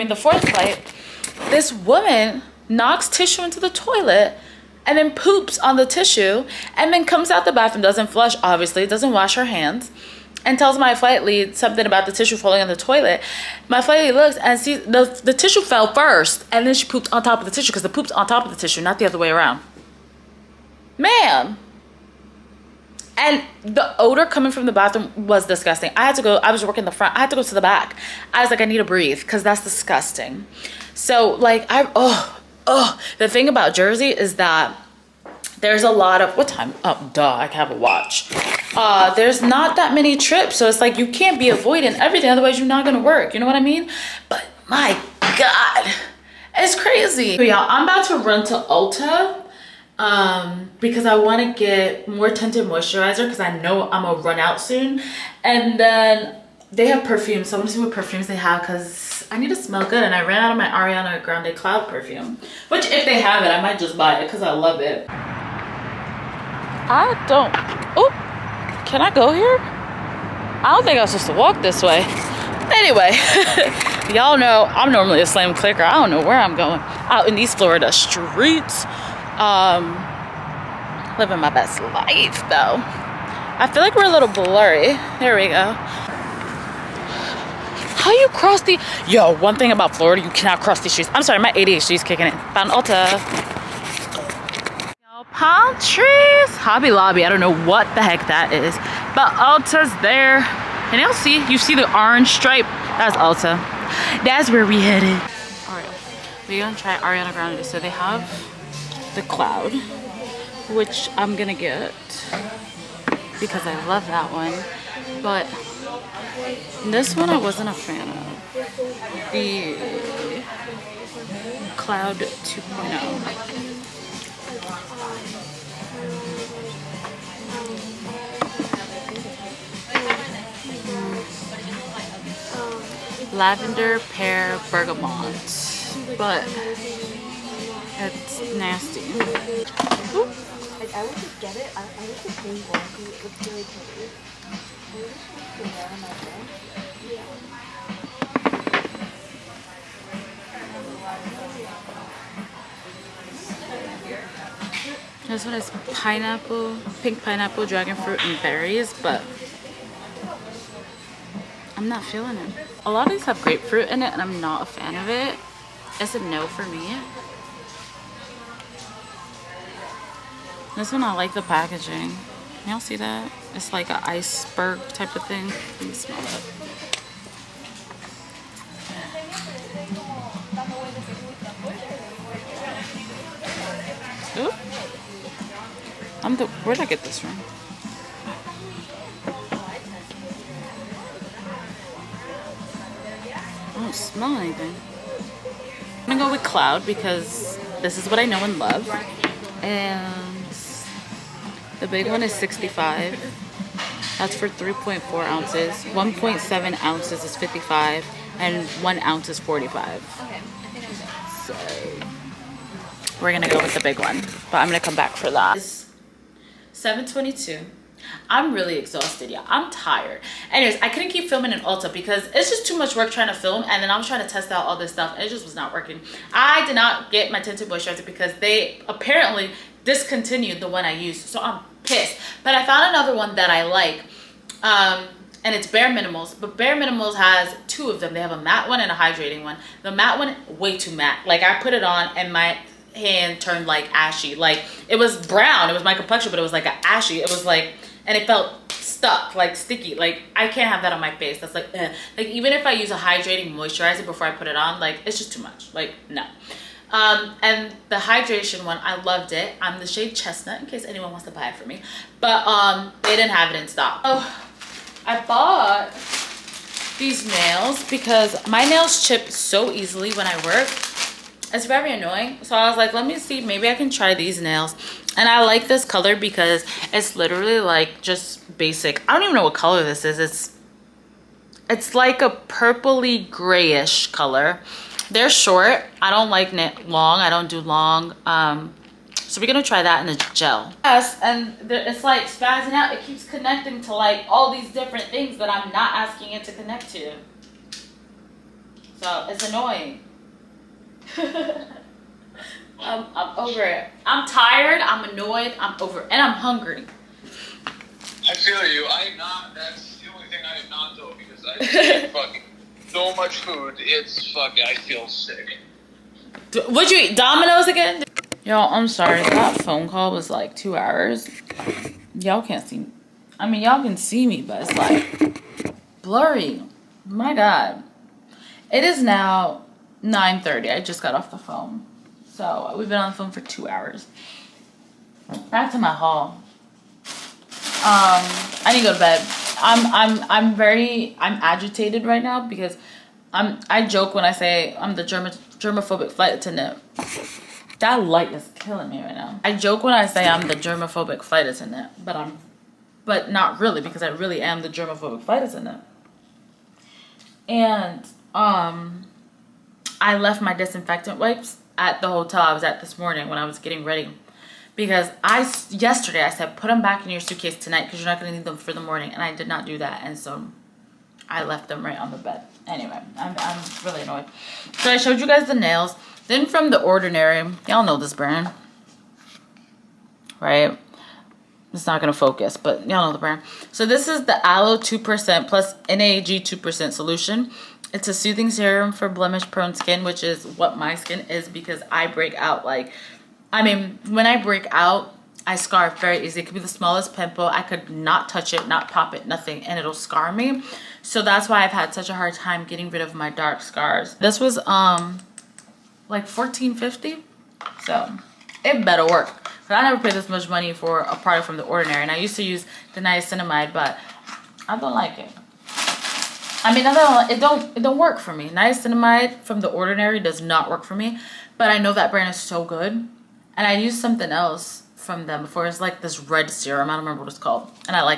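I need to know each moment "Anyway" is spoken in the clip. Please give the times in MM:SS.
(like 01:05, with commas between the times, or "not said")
01:12, 03:40, 06:12.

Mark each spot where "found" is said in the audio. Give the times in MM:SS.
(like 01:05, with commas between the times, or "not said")
01:32, 03:52.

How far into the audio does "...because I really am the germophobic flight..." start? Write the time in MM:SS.
05:53.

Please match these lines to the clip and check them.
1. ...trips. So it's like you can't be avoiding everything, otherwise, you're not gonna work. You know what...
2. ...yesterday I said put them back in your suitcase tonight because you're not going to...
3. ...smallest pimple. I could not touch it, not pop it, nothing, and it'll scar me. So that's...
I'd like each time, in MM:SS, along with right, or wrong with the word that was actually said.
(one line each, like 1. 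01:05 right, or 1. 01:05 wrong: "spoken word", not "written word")
1. 00:40 right
2. 06:05 right
3. 06:36 right.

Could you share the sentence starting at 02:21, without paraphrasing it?
I, I wish the pink one it looks really pretty.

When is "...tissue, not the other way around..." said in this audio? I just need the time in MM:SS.
00:18.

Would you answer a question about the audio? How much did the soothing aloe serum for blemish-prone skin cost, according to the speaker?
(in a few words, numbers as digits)
14.50.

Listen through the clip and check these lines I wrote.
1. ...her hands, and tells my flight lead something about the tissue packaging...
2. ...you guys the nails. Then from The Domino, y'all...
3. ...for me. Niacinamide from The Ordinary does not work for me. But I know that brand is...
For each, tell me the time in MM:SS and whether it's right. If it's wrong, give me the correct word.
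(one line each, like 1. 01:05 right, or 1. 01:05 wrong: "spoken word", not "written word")
1. 00:09 wrong: "falling", not "packaging"
2. 06:15 wrong: "Ordinary", not "Domino"
3. 06:58 right.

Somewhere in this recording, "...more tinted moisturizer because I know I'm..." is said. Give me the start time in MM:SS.
00:52.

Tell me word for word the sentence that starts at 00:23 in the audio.
And the odor coming from the bathroom was disgusting.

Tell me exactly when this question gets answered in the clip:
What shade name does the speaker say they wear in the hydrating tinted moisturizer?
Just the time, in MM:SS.
04:20.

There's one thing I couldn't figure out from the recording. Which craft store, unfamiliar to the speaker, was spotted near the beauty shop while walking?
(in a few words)
Hobby Lobby.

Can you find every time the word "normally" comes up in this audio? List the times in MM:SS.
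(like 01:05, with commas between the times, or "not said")
01:14.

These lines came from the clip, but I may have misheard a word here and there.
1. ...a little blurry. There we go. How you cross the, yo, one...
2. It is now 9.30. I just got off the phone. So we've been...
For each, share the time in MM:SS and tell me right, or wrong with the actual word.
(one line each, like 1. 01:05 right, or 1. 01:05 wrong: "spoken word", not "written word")
1. 01:24 right
2. 05:28 right.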